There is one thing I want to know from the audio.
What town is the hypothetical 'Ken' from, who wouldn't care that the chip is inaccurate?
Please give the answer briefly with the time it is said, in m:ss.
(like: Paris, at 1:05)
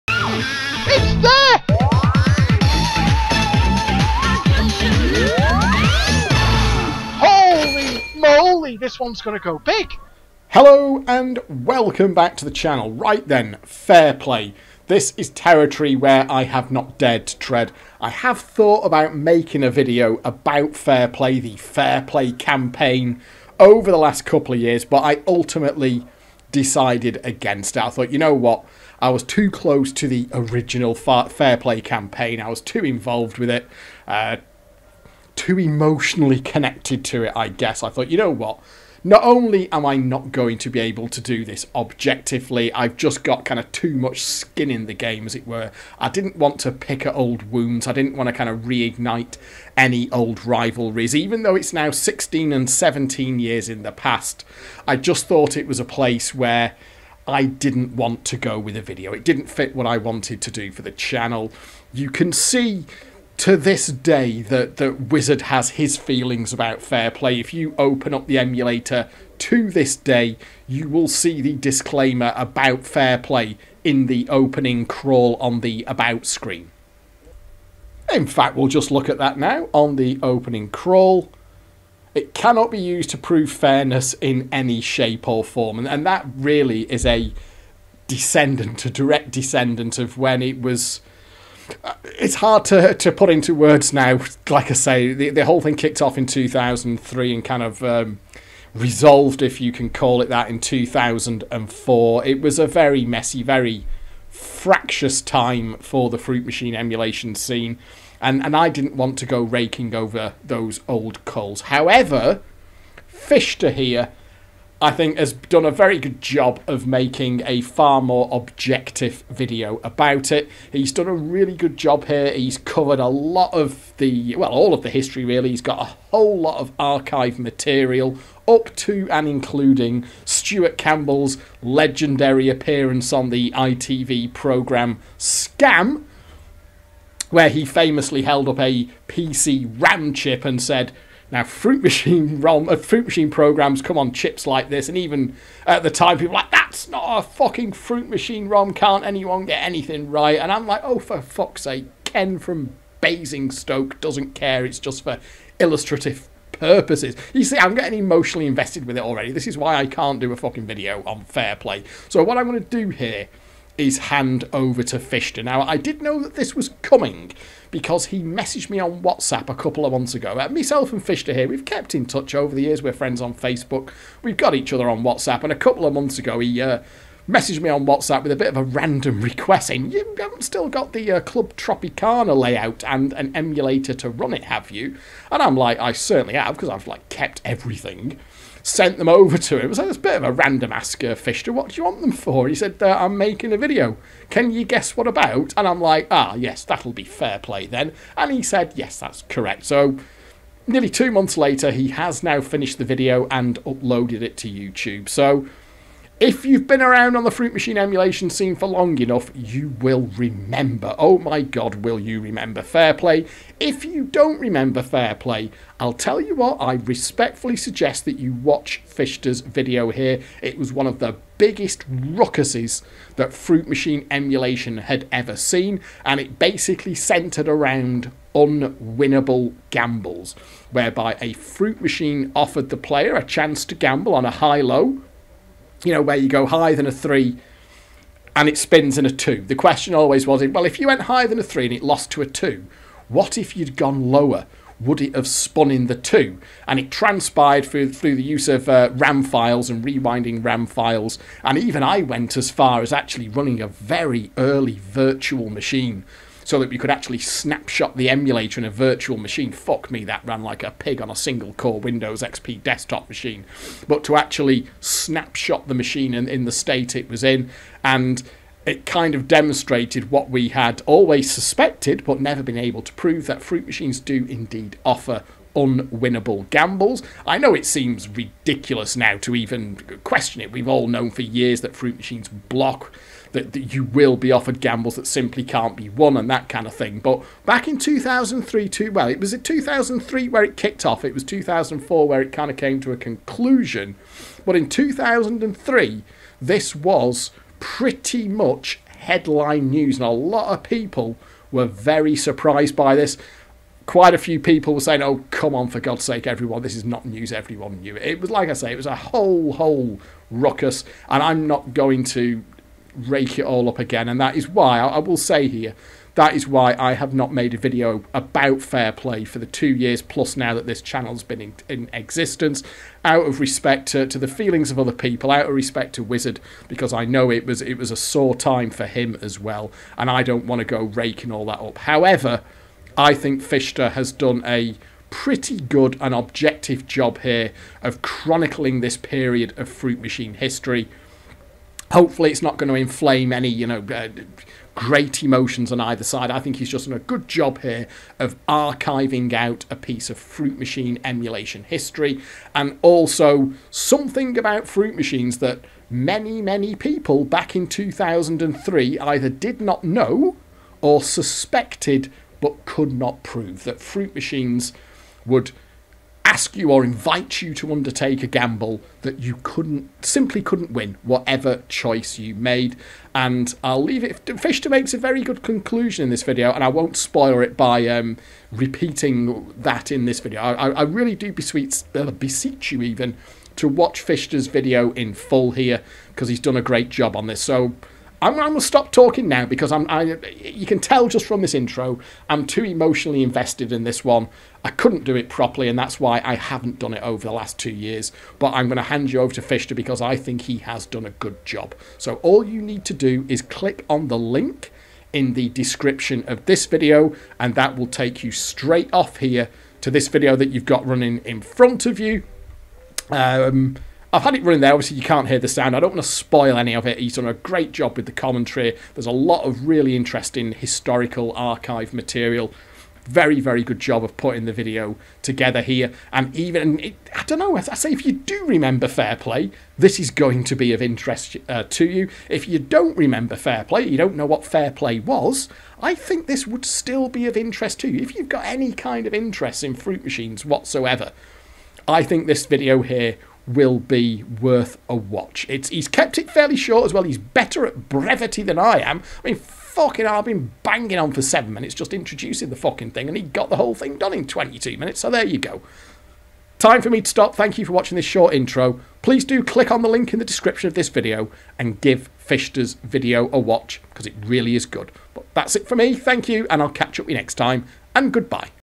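Basingstoke, at 2:32.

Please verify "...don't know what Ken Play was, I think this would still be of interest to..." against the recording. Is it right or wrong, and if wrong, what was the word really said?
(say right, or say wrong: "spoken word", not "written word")
wrong: "Fair", not "Ken".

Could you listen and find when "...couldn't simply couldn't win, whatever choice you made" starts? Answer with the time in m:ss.
6:09.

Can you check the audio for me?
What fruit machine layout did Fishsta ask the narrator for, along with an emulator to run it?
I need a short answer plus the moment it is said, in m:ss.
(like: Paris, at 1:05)
Club Tropicana, at 3:01.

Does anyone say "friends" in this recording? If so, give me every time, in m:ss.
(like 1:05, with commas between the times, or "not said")
2:52.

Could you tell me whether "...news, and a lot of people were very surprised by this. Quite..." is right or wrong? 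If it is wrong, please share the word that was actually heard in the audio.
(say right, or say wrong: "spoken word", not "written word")
right.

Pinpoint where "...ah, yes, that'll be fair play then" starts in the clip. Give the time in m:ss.
3:16.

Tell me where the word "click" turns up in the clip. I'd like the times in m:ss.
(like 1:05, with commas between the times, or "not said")
6:43, 7:39.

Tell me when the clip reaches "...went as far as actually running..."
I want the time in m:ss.
4:12.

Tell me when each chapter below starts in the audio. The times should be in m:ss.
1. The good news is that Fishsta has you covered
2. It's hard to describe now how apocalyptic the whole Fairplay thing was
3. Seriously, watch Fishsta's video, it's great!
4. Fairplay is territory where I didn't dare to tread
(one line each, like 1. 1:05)
1. 1:51
2. 3:33
3. 5:31
4. 0:10.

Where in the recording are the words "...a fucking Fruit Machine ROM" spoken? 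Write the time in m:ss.
2:27.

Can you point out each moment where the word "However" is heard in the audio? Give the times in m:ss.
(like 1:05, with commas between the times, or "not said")
1:51, 5:31.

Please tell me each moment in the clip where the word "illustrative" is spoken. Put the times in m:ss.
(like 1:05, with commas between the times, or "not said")
2:35.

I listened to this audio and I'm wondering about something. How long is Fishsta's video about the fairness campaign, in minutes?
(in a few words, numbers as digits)
22 minutes.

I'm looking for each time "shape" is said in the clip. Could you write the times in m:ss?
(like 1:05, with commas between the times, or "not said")
1:24.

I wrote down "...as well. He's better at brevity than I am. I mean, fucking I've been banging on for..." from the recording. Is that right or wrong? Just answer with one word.
right.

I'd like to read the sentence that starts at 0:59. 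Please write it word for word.
It didn't fit what I wanted to do for the channel.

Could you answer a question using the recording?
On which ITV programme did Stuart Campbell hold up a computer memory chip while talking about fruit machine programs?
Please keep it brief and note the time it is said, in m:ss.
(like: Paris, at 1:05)
Scam, at 2:15.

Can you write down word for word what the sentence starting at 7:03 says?
Very, very good job of putting the video together here.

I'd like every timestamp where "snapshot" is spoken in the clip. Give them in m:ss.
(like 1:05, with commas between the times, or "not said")
4:17, 4:24.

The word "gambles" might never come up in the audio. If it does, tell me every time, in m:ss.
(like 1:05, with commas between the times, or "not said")
3:49, 3:53, 4:36, 4:44, 6:08.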